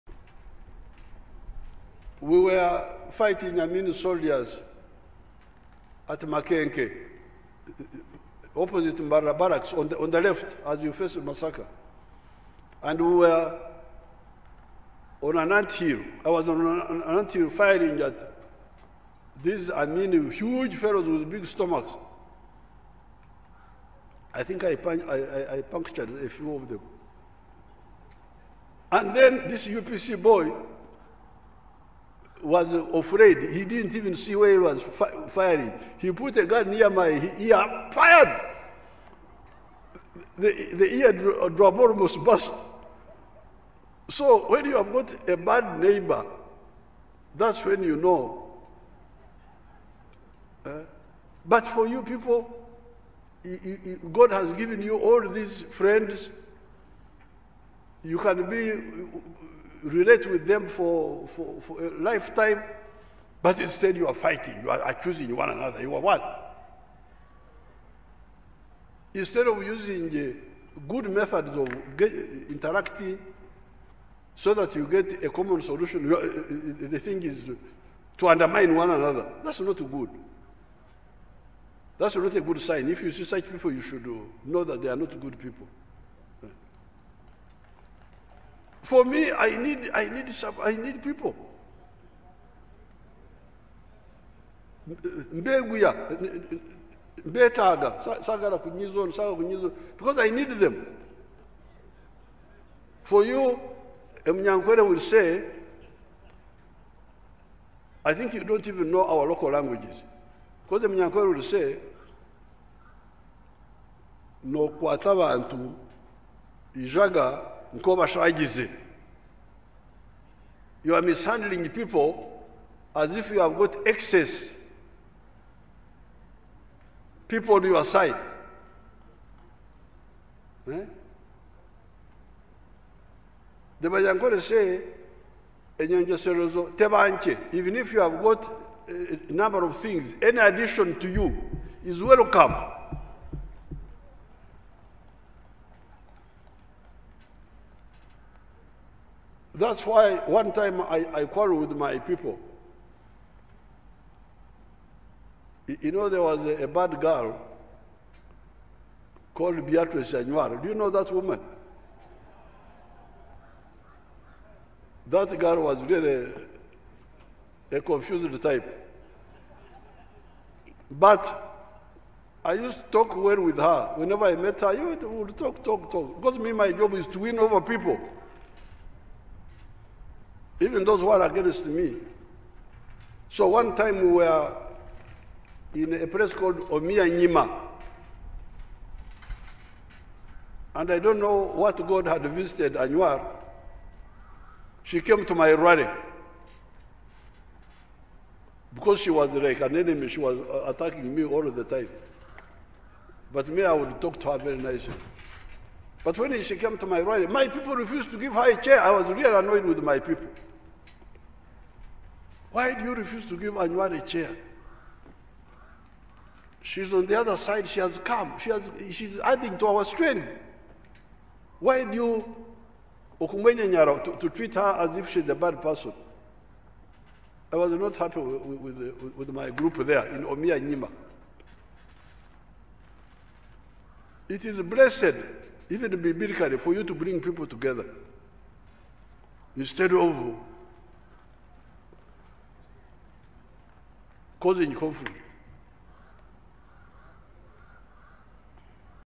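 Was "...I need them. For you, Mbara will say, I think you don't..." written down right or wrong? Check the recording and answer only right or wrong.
wrong.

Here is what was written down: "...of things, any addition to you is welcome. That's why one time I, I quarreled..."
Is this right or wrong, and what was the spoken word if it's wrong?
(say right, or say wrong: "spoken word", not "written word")
right.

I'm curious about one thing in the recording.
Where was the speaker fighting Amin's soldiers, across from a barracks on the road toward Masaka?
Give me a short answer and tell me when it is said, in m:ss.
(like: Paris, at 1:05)
Makenke, at 0:06.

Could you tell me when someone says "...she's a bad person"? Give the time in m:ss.
3:45.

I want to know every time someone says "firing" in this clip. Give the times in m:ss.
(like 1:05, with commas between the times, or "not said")
0:17, 0:35.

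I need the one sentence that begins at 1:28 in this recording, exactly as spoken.
For me, I need, I need, I need people.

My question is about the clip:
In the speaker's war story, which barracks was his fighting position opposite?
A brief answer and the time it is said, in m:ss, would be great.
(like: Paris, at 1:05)
Mbara barracks, at 0:08.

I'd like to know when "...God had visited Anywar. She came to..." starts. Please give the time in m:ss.
3:11.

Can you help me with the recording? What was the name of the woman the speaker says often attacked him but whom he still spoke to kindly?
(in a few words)
Beatrice Anywar.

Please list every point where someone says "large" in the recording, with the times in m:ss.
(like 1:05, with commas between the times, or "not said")
not said.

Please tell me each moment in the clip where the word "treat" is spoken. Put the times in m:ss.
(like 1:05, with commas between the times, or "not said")
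3:44.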